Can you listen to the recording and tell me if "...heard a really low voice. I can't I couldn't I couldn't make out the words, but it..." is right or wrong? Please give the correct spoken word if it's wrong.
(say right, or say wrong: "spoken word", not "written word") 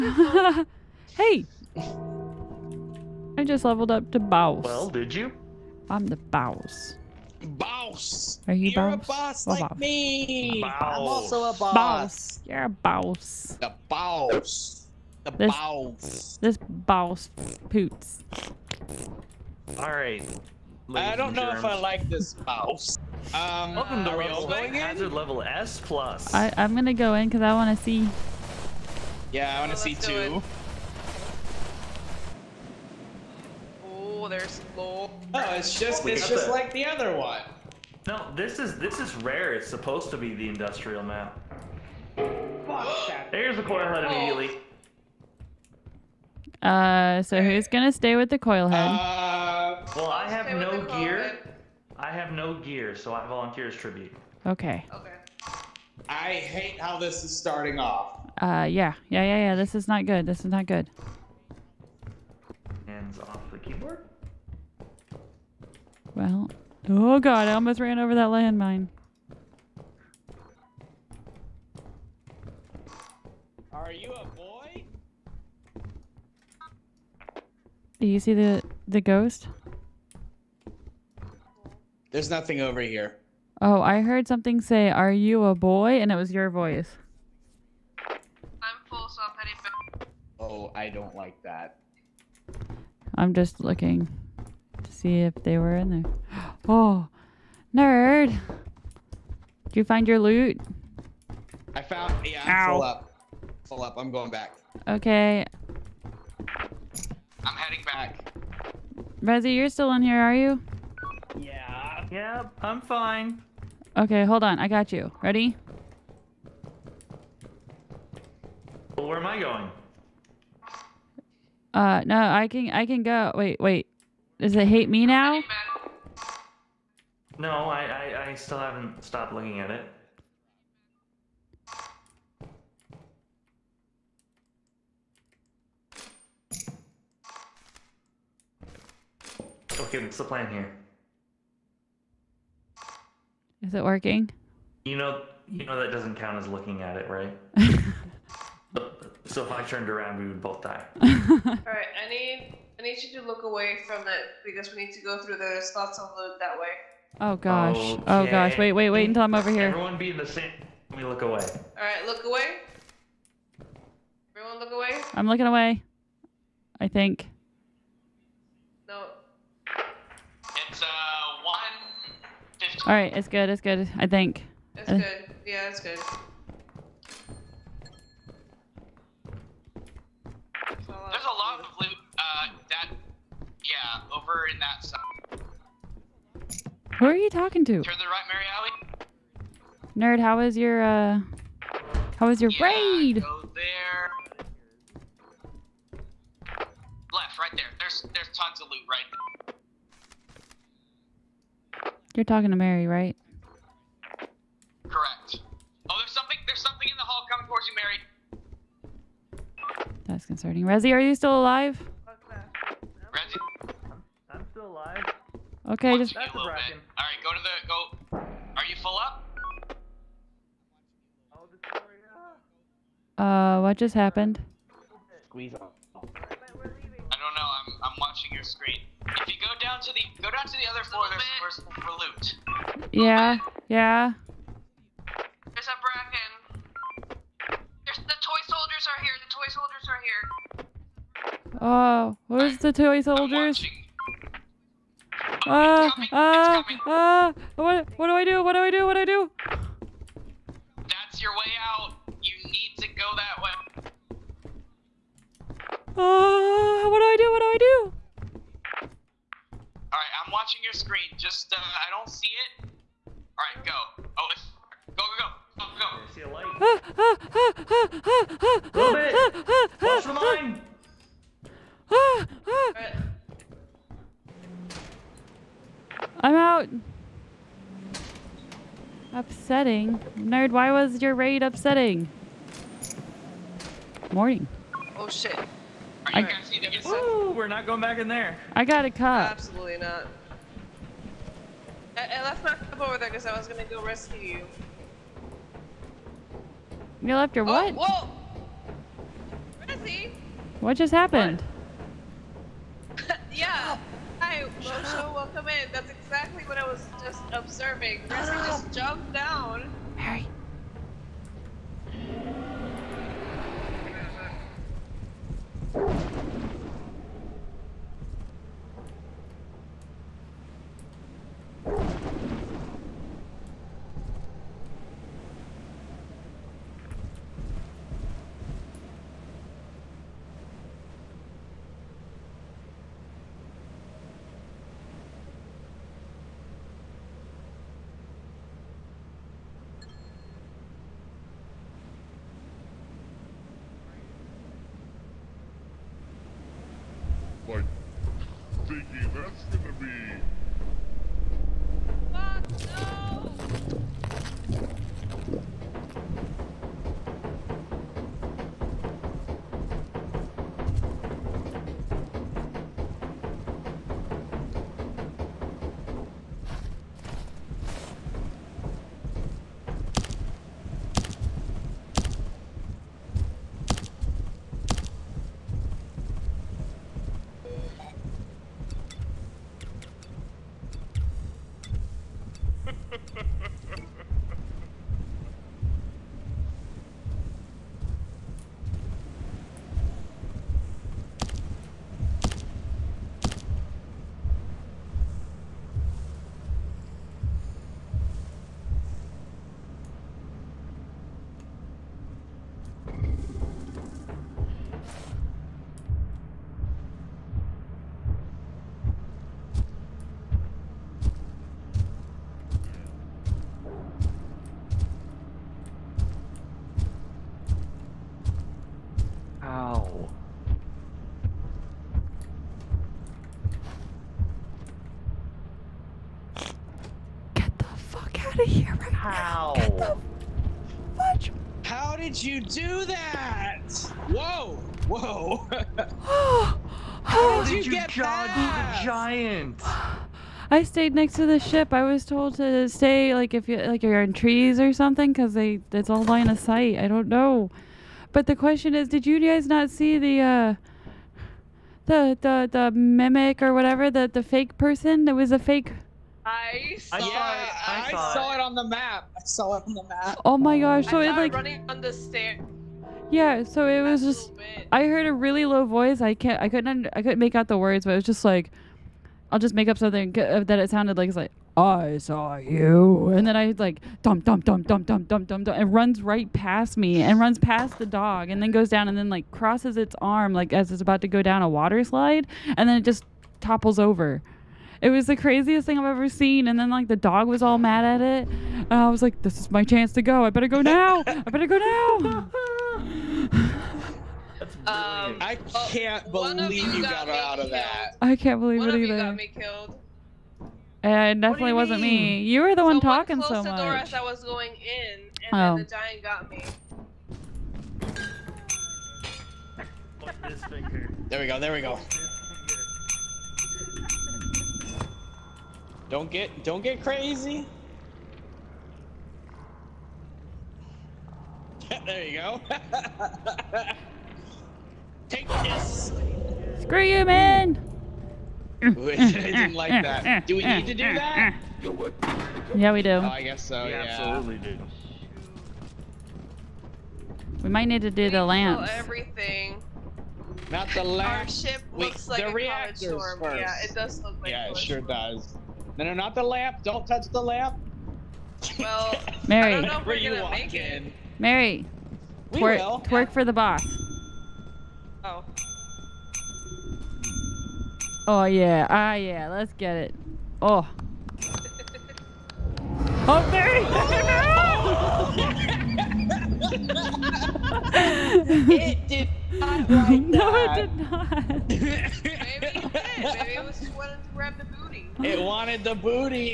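right.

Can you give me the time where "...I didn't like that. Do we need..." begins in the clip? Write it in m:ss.
8:48.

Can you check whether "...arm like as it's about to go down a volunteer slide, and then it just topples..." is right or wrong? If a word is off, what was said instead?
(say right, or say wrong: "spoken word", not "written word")
wrong: "water", not "volunteer".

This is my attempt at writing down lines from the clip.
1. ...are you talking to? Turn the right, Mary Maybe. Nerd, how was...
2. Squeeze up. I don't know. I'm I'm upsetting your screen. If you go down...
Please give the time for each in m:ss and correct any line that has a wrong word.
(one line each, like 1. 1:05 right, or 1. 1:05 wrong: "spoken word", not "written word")
1. 3:07 wrong: "Alley", not "Maybe"
2. 3:45 wrong: "watching", not "upsetting".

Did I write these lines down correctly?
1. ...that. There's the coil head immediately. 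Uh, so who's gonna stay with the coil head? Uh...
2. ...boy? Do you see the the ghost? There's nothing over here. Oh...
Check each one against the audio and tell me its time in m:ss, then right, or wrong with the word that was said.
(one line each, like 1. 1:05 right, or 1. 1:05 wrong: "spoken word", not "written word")
1. 0:43 right
2. 1:14 right.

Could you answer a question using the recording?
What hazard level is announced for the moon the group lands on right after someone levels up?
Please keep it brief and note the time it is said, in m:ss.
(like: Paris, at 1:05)
S plus, at 0:24.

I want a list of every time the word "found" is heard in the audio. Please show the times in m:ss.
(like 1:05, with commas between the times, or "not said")
1:41.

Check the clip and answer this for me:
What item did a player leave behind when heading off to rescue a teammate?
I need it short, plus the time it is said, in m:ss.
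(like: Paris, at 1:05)
cup, at 4:52.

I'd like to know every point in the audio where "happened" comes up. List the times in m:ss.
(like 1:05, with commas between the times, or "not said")
3:43, 5:00.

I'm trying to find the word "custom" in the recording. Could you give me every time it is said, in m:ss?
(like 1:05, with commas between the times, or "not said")
not said.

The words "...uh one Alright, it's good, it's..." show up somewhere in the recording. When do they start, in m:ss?
2:50.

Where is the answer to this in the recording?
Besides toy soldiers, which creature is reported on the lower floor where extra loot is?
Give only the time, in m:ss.
3:55.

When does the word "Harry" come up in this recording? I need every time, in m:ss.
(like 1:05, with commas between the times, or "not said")
5:09.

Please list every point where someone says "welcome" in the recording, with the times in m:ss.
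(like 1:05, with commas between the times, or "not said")
0:23, 5:05.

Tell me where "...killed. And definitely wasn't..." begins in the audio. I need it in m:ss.
8:19.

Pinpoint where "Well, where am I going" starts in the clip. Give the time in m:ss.
1:58.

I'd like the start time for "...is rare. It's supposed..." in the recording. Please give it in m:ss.
0:39.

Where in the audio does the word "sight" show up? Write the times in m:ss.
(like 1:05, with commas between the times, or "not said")
7:26.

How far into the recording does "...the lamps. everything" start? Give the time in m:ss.
8:58.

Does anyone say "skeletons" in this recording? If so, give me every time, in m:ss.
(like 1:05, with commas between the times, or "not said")
not said.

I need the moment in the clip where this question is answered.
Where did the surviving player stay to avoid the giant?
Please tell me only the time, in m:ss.
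7:20.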